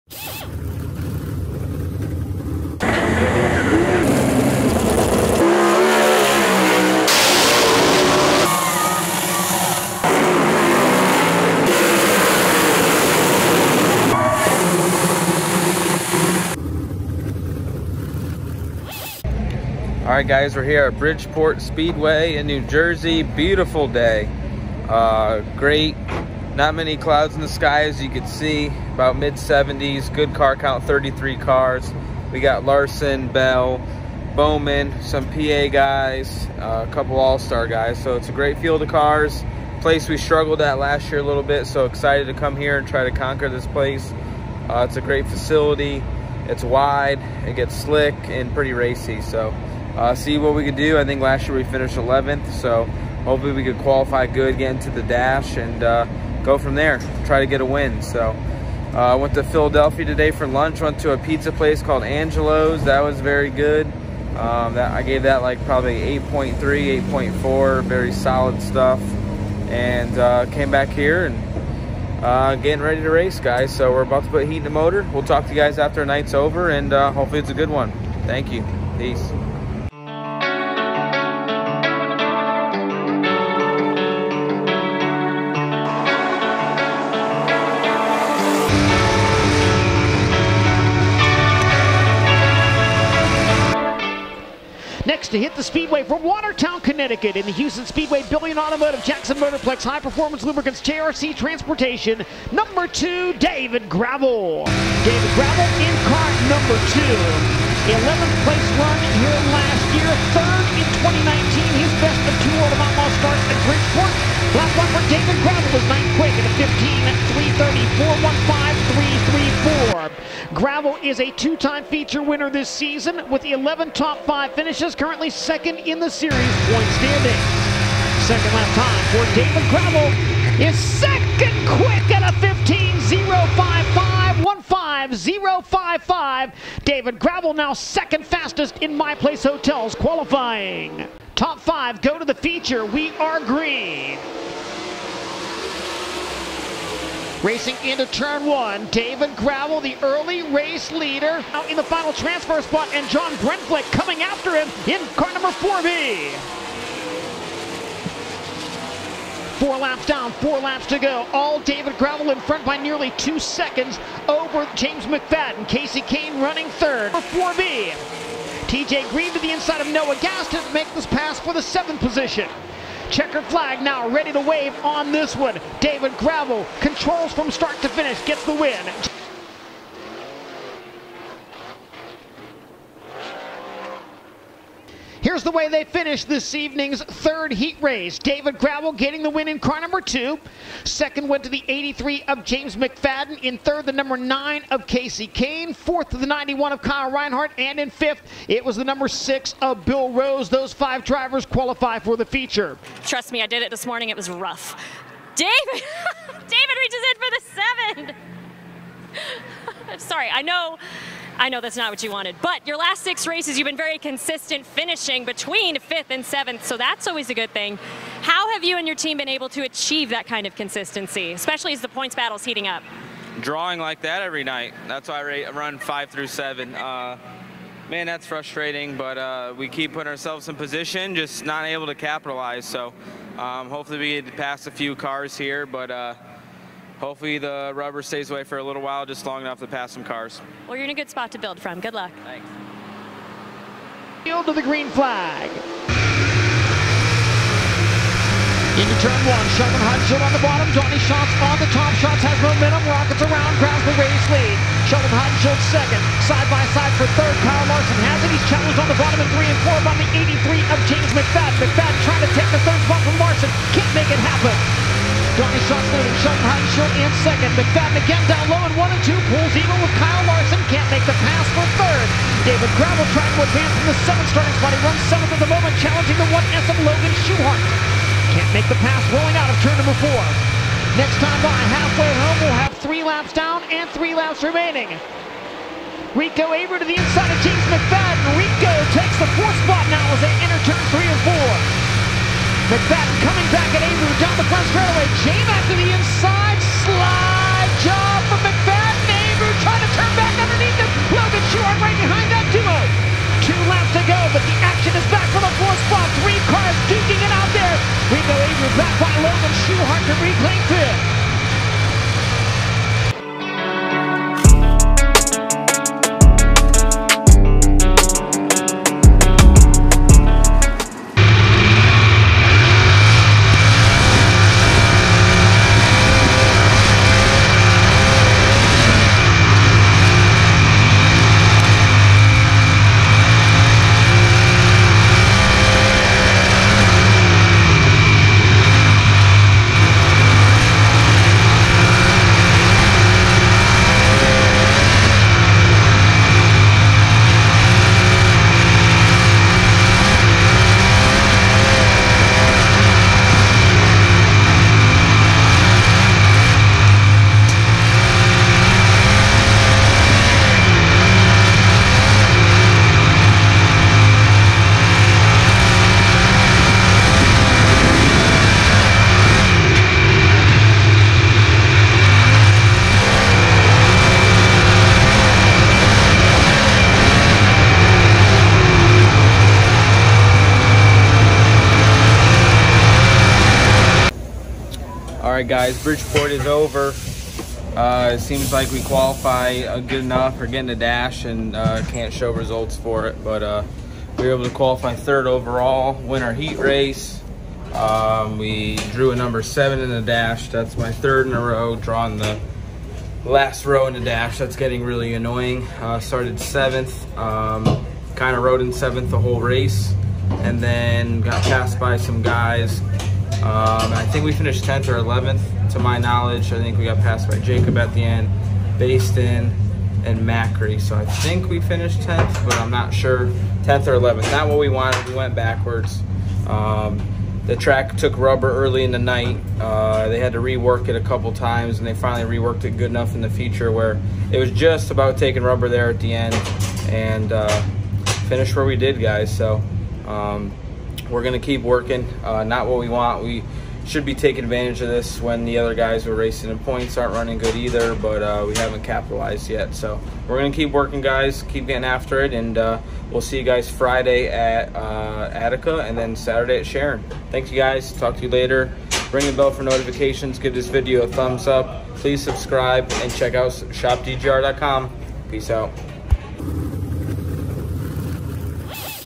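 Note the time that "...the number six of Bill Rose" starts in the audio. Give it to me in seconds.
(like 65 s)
198 s.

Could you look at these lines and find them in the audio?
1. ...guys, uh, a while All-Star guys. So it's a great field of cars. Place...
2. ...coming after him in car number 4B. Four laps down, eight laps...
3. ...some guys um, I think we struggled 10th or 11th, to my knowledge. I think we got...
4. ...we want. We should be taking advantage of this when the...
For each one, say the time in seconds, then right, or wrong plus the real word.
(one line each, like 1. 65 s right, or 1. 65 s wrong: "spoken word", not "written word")
1. 35 s wrong: "couple", not "while"
2. 153 s wrong: "four", not "eight"
3. 411 s wrong: "finished", not "struggled"
4. 442 s right.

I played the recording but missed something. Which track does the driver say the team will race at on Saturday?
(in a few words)
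Sharon.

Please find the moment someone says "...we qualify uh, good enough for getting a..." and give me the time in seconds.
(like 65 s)
388 s.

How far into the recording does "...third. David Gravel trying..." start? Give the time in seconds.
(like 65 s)
271 s.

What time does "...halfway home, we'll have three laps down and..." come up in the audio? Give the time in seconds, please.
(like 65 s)
281 s.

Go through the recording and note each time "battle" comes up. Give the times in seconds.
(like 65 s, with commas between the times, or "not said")
222 s.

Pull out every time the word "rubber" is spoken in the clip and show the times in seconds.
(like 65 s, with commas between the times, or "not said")
237 s, 428 s, 435 s.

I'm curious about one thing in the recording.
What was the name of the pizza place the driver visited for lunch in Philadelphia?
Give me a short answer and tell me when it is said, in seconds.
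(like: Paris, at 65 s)
Angelo's, at 62 s.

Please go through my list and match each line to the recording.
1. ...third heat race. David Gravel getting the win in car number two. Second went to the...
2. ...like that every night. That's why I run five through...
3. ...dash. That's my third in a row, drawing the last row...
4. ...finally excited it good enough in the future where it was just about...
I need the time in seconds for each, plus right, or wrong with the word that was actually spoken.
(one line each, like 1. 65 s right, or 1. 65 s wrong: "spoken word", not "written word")
1. 187 s right
2. 223 s right
3. 400 s right
4. 431 s wrong: "reworked", not "excited".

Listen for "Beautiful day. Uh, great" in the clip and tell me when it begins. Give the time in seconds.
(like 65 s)
23 s.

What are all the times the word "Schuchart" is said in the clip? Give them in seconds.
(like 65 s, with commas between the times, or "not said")
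277 s, 309 s.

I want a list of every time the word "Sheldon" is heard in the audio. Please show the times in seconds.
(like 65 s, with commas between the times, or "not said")
249 s, 254 s, 266 s.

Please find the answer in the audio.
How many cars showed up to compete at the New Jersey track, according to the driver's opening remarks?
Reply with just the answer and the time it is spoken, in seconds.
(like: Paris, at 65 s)
33, at 30 s.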